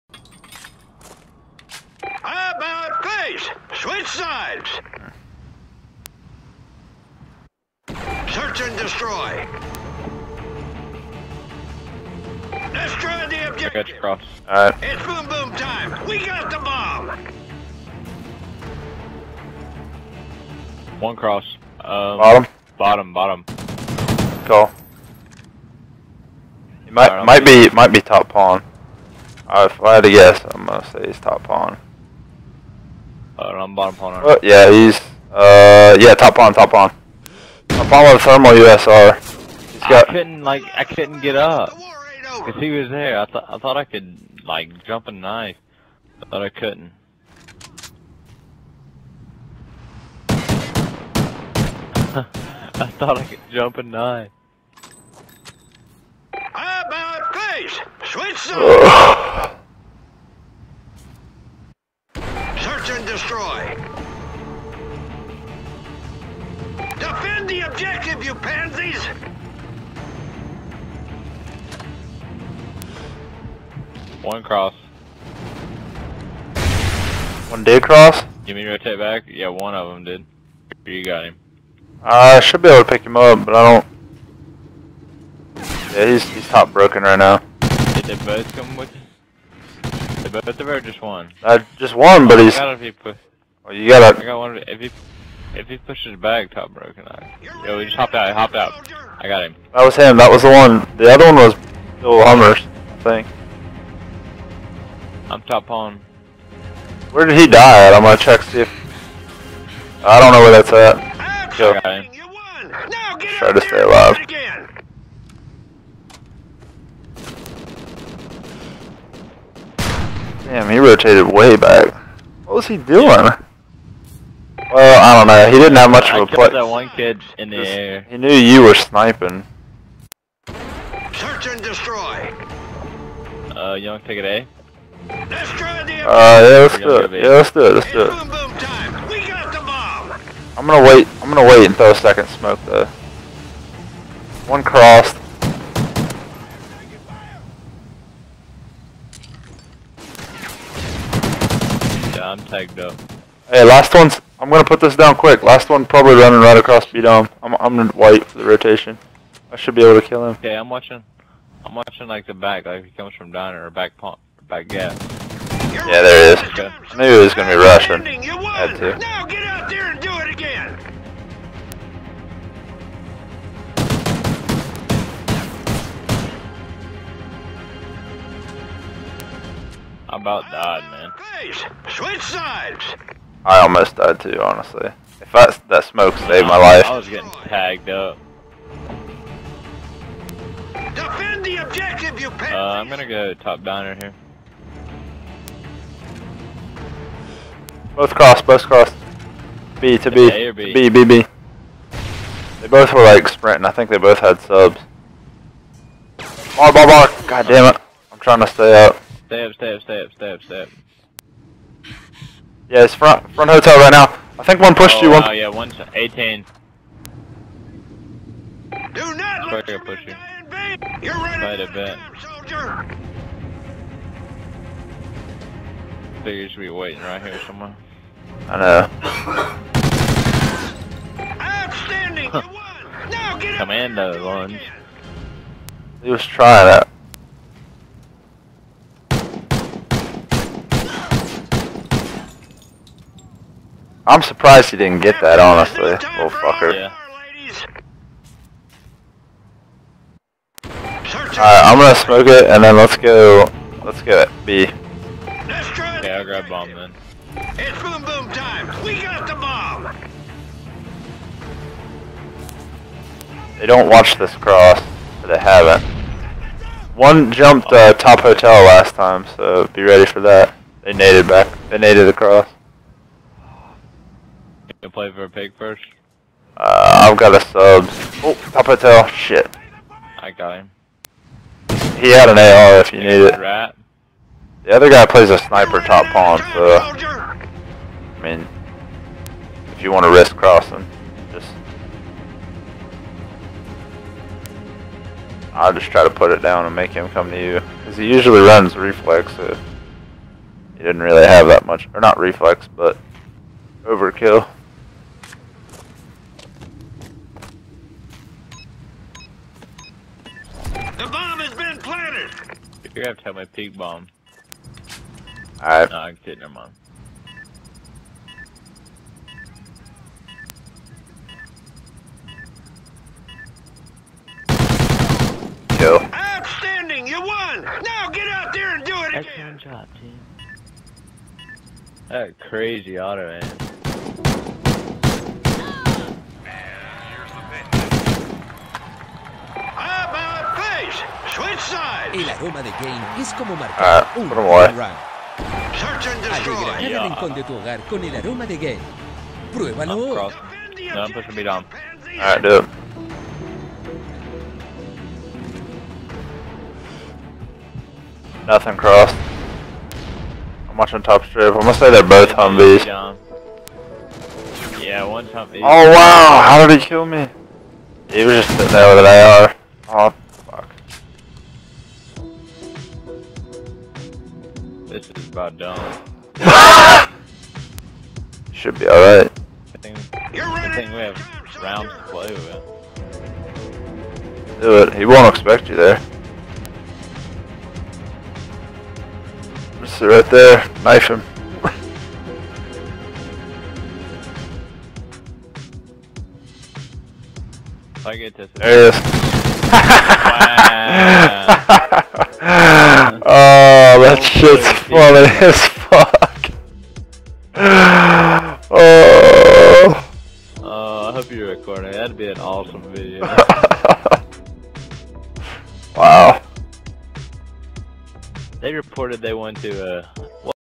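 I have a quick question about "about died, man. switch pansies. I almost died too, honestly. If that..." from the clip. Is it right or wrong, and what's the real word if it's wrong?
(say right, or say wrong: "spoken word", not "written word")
wrong: "sides", not "pansies".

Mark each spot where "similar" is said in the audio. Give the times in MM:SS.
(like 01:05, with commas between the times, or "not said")
not said.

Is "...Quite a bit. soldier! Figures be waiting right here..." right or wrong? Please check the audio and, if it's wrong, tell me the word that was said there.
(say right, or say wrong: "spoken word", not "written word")
right.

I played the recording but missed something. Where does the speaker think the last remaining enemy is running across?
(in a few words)
B dome.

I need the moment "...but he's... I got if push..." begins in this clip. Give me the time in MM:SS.
01:32.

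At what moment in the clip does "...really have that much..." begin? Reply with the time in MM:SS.
05:01.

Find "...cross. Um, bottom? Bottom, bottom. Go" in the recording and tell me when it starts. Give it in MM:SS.
00:21.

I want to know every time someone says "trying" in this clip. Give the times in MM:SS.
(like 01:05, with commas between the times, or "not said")
03:28, 03:56.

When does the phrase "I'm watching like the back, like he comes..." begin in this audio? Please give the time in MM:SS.
02:41.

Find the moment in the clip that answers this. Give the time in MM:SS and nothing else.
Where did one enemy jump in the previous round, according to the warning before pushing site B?
04:27.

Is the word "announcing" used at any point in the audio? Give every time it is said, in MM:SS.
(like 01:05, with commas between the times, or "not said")
not said.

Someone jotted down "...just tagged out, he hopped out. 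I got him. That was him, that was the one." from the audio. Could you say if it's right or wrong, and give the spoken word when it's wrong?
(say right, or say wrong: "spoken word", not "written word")
wrong: "hopped", not "tagged".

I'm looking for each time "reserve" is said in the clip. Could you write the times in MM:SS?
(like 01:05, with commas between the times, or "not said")
not said.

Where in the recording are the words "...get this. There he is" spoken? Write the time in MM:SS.
06:38.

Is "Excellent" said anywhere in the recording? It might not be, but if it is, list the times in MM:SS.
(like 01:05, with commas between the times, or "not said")
05:29.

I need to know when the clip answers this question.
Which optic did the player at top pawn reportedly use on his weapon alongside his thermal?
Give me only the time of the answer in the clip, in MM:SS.
00:38.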